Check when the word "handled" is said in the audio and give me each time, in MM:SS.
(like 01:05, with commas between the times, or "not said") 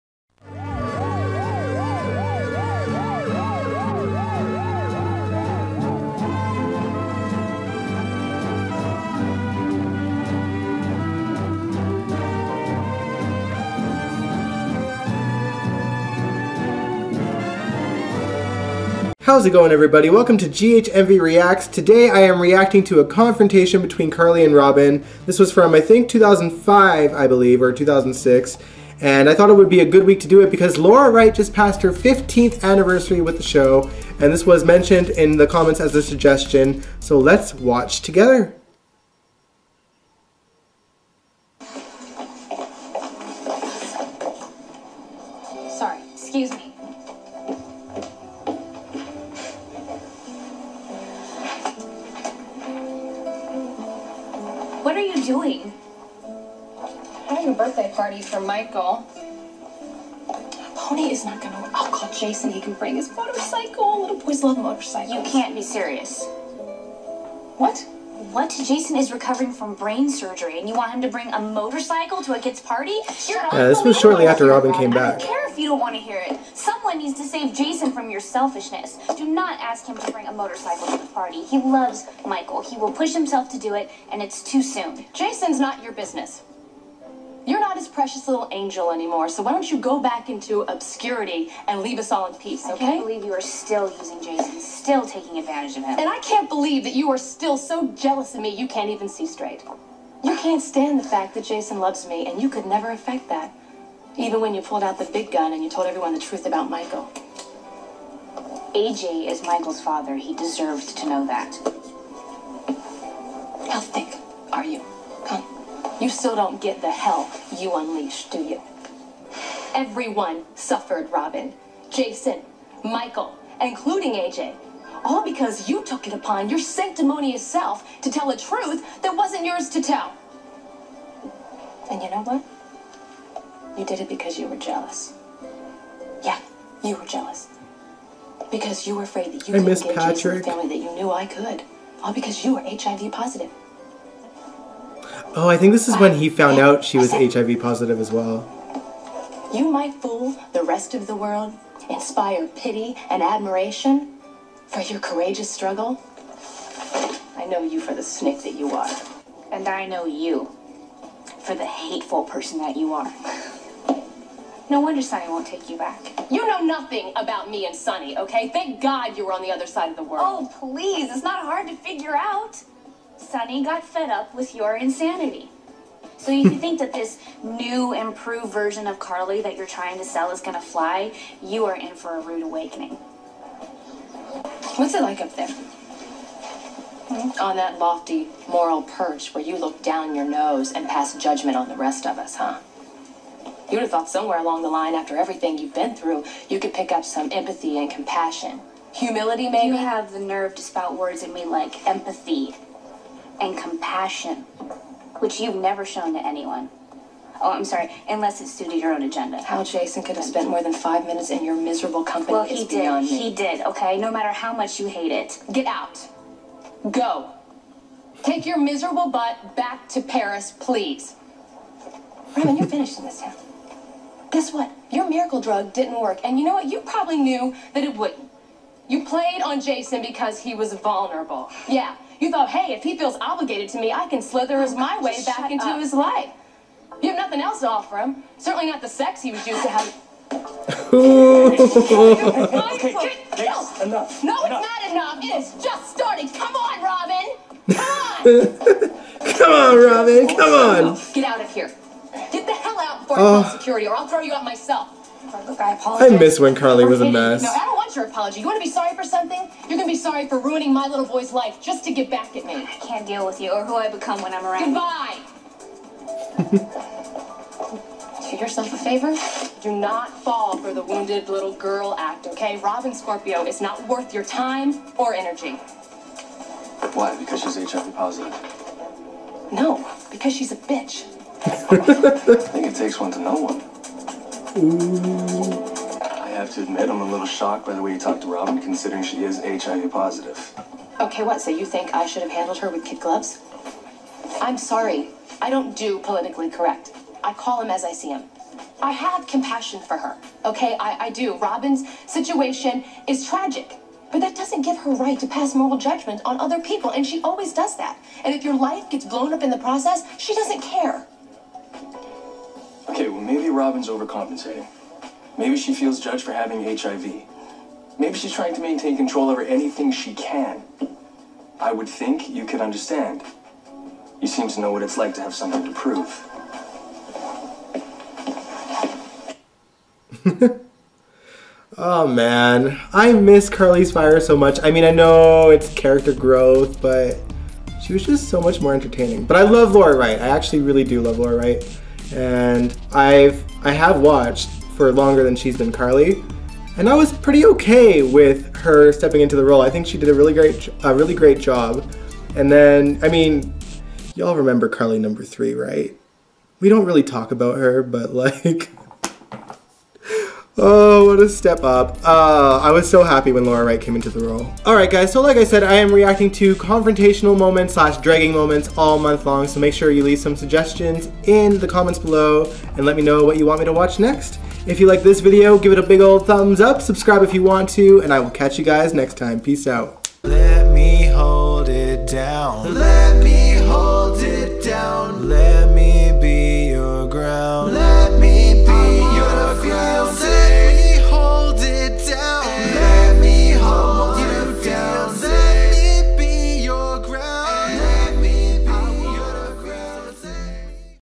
04:52.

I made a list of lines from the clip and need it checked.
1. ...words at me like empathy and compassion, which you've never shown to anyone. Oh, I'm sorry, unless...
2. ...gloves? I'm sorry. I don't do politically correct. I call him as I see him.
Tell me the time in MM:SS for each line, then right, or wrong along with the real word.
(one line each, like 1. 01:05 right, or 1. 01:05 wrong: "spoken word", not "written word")
1. 03:20 right
2. 04:52 right.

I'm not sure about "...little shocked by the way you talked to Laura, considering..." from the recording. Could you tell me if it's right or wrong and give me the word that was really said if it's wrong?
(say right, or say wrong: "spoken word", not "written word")
wrong: "Robin", not "Laura".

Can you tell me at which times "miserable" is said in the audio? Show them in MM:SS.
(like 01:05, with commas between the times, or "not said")
03:31, 03:38.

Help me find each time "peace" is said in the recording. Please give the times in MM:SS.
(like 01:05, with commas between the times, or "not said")
01:32, 06:19.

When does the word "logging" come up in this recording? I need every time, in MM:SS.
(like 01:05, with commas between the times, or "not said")
not said.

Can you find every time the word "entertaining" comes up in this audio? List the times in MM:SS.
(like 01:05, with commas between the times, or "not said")
05:38.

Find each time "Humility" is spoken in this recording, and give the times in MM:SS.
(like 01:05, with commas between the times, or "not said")
03:18.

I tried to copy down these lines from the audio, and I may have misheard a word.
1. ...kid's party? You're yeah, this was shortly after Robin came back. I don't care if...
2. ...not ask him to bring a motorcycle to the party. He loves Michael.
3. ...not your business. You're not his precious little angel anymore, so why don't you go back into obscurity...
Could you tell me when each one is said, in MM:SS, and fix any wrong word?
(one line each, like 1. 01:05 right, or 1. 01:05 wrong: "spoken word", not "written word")
1. 01:12 right
2. 01:19 right
3. 01:25 right.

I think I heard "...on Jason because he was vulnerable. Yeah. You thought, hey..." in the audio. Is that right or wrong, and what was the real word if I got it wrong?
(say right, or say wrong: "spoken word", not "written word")
right.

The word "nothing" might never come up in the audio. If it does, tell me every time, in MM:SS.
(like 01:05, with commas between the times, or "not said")
02:46, 03:57.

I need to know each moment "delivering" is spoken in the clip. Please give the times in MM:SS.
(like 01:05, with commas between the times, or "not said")
not said.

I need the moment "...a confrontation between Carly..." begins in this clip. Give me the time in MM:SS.
00:23.